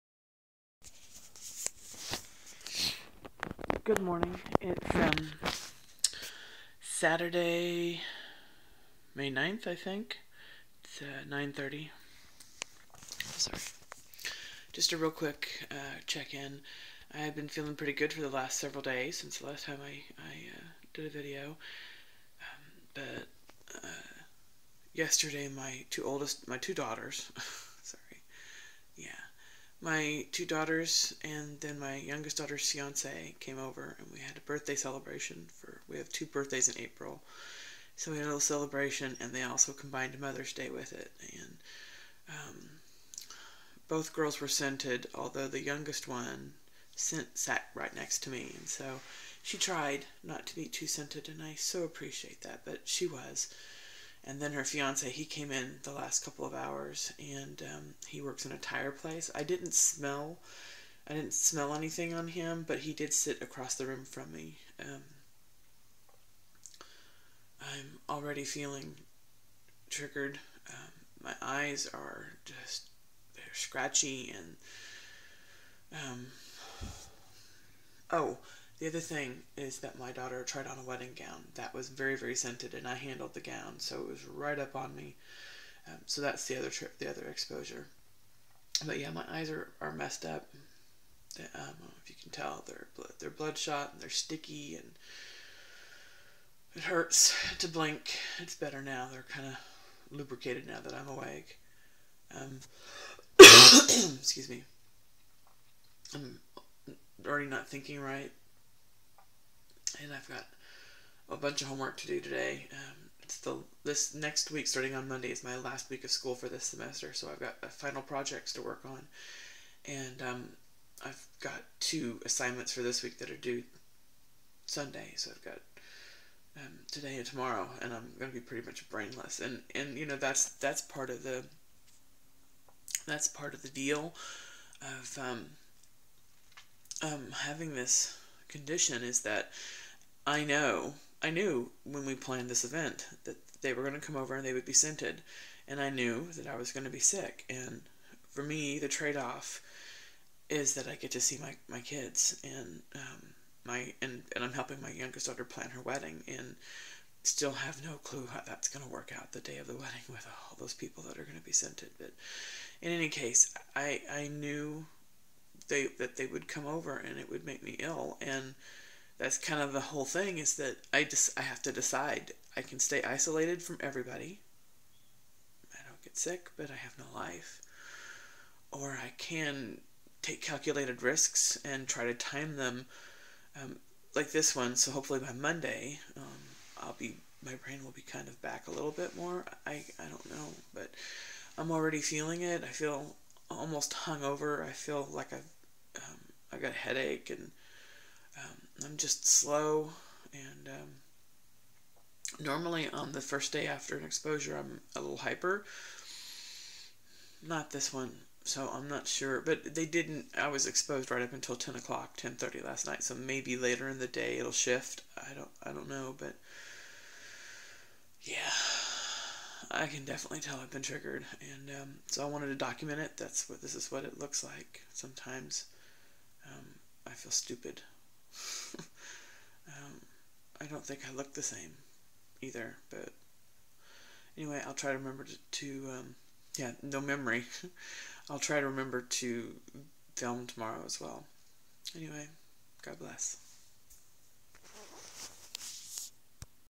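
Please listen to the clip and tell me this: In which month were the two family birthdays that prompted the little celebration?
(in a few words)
April.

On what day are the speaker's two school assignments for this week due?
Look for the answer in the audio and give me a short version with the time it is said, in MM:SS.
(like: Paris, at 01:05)
Sunday, at 02:04.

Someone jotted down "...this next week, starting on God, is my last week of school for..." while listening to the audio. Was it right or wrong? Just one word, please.
wrong.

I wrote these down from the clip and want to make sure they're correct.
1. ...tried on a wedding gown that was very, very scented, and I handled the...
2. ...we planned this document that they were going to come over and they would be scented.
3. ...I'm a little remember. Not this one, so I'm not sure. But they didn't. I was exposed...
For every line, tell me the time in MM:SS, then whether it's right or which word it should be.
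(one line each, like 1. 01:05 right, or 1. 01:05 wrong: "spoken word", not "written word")
1. 01:20 right
2. 02:22 wrong: "event", not "document"
3. 03:24 wrong: "hyper", not "remember".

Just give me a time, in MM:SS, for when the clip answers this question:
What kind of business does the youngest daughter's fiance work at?
00:58.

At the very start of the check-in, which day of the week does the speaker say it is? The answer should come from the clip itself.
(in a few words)
Saturday.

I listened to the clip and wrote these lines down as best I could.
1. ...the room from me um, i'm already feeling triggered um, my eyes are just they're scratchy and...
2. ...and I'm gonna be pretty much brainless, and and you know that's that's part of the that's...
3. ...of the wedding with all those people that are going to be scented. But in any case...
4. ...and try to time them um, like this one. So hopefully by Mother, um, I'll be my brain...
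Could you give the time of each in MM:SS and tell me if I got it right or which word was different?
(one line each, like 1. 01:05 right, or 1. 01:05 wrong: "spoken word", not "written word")
1. 01:03 right
2. 02:07 right
3. 02:39 right
4. 03:01 wrong: "Monday", not "Mother".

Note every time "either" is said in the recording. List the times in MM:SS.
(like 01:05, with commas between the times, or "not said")
03:52.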